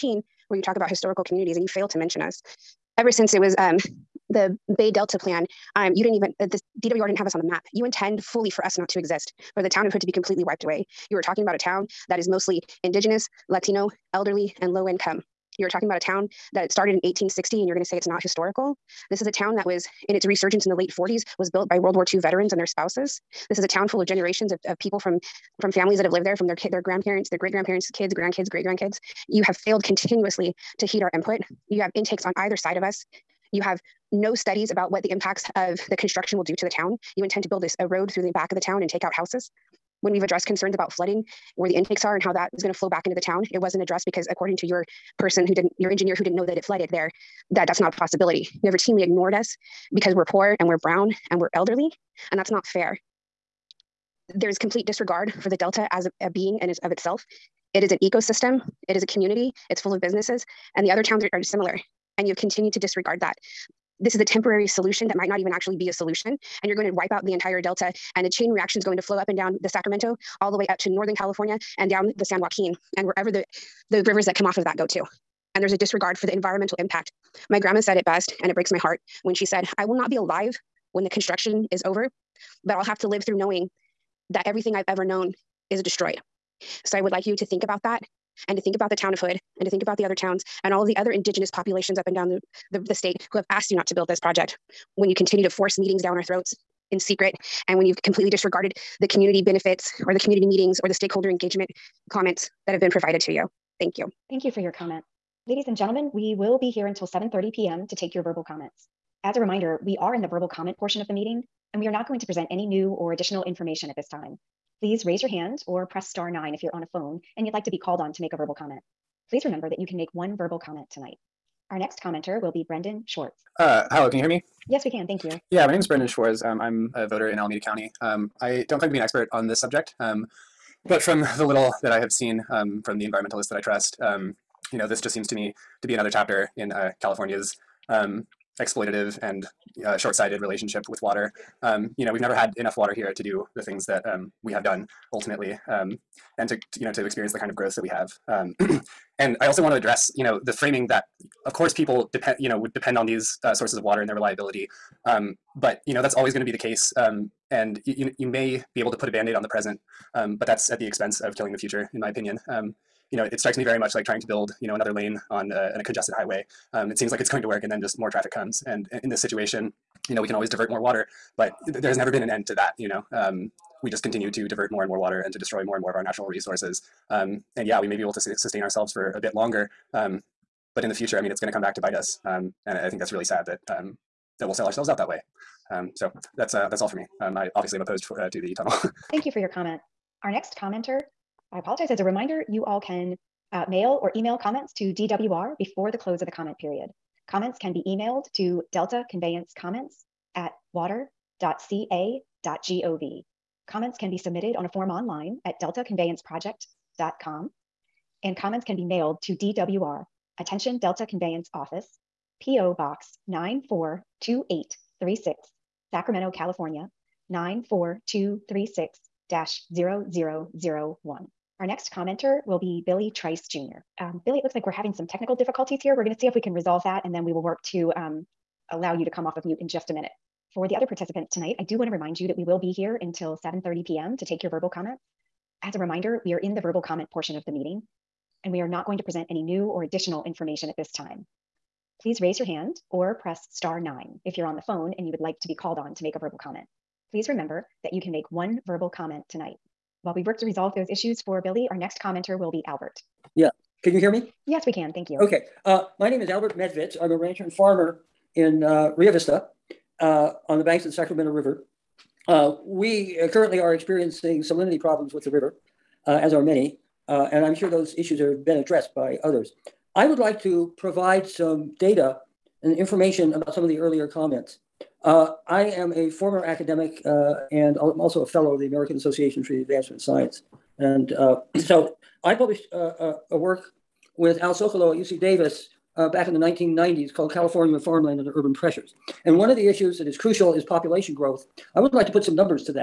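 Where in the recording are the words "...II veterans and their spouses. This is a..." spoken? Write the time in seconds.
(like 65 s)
22 s.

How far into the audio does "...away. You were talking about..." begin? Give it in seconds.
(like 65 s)
10 s.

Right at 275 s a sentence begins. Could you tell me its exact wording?
Uh, I am a former academic uh, and I'm also a fellow of the American Association for the Advancement of Science.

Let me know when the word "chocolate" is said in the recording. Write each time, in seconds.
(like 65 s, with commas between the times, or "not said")
not said.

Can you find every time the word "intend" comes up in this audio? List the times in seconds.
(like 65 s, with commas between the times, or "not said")
7 s, 37 s.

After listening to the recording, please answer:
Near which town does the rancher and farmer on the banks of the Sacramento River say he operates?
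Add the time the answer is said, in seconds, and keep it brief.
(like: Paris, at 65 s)
Rio Vista, at 258 s.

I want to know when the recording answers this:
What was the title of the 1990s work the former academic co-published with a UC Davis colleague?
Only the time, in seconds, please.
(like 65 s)
287 s.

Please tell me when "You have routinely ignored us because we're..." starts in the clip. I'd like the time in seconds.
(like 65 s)
48 s.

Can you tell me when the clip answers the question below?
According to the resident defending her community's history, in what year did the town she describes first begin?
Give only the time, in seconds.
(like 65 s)
17 s.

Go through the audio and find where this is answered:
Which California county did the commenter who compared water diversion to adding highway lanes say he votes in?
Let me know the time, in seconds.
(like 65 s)
127 s.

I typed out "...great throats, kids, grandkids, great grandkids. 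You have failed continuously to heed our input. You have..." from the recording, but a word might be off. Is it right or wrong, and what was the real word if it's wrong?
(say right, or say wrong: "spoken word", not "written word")
wrong: "grandparents", not "throats".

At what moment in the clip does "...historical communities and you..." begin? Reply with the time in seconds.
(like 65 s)
0 s.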